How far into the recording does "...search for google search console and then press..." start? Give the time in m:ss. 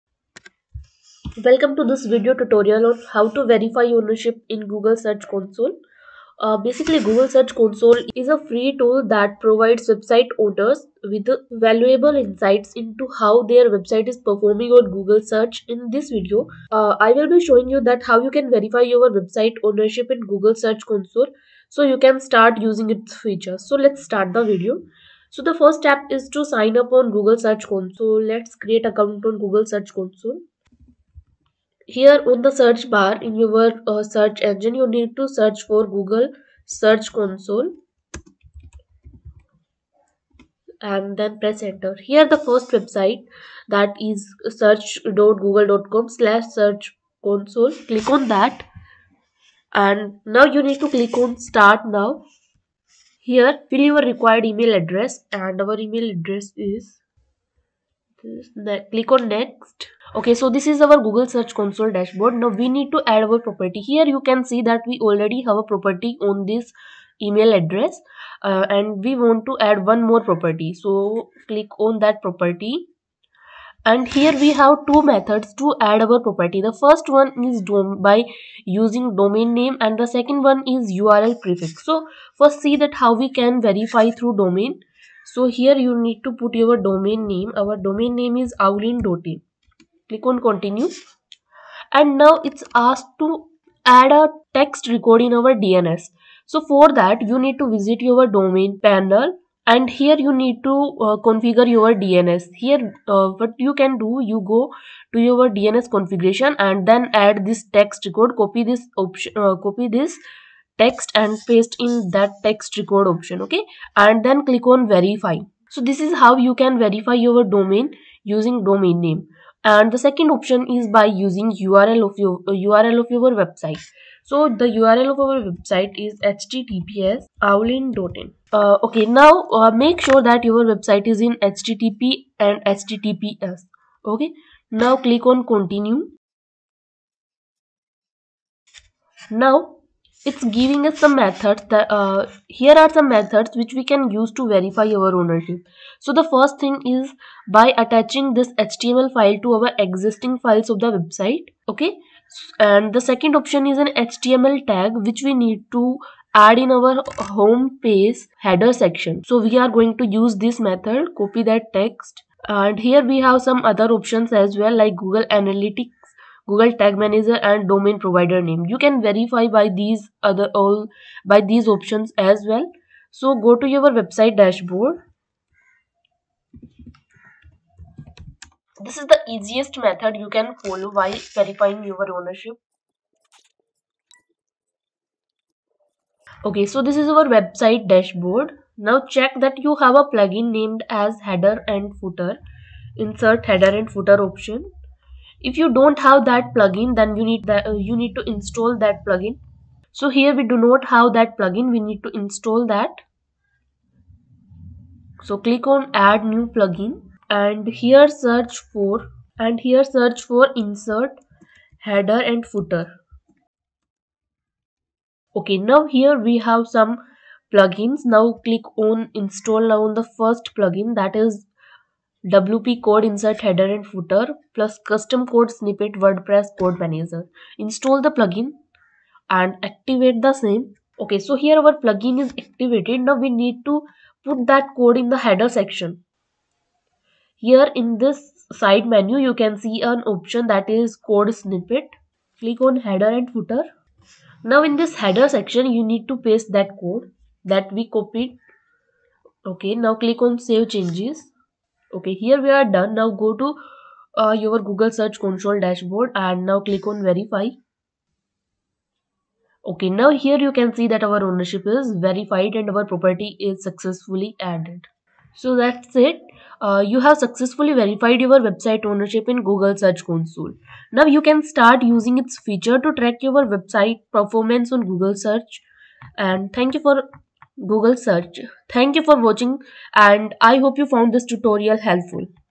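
0:35.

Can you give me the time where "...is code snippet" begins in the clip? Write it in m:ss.
4:00.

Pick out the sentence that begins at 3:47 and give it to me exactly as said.
Install the plugin and activate the same.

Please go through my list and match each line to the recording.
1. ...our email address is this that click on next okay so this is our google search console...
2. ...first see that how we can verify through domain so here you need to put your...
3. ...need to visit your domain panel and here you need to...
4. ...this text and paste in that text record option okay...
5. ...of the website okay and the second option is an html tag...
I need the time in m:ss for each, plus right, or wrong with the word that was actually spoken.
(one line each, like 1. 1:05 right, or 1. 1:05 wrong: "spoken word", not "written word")
1. 0:55 right
2. 1:22 right
3. 1:37 right
4. 1:49 right
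5. 2:30 right.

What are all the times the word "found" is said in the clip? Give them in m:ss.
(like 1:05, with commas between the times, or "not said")
4:40.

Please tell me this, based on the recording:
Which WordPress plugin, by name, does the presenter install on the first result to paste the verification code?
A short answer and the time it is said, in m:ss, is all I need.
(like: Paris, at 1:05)
WP code, at 3:42.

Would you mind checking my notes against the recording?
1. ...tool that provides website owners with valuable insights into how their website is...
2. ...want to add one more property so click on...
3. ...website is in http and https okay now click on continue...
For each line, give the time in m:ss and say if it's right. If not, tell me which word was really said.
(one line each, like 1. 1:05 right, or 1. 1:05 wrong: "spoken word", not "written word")
1. 0:08 right
2. 1:09 right
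3. 2:10 right.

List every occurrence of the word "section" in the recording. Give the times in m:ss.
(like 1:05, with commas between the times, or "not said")
2:38, 3:55, 4:05.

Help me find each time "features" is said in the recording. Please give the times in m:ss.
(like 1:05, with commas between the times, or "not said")
0:23, 4:32.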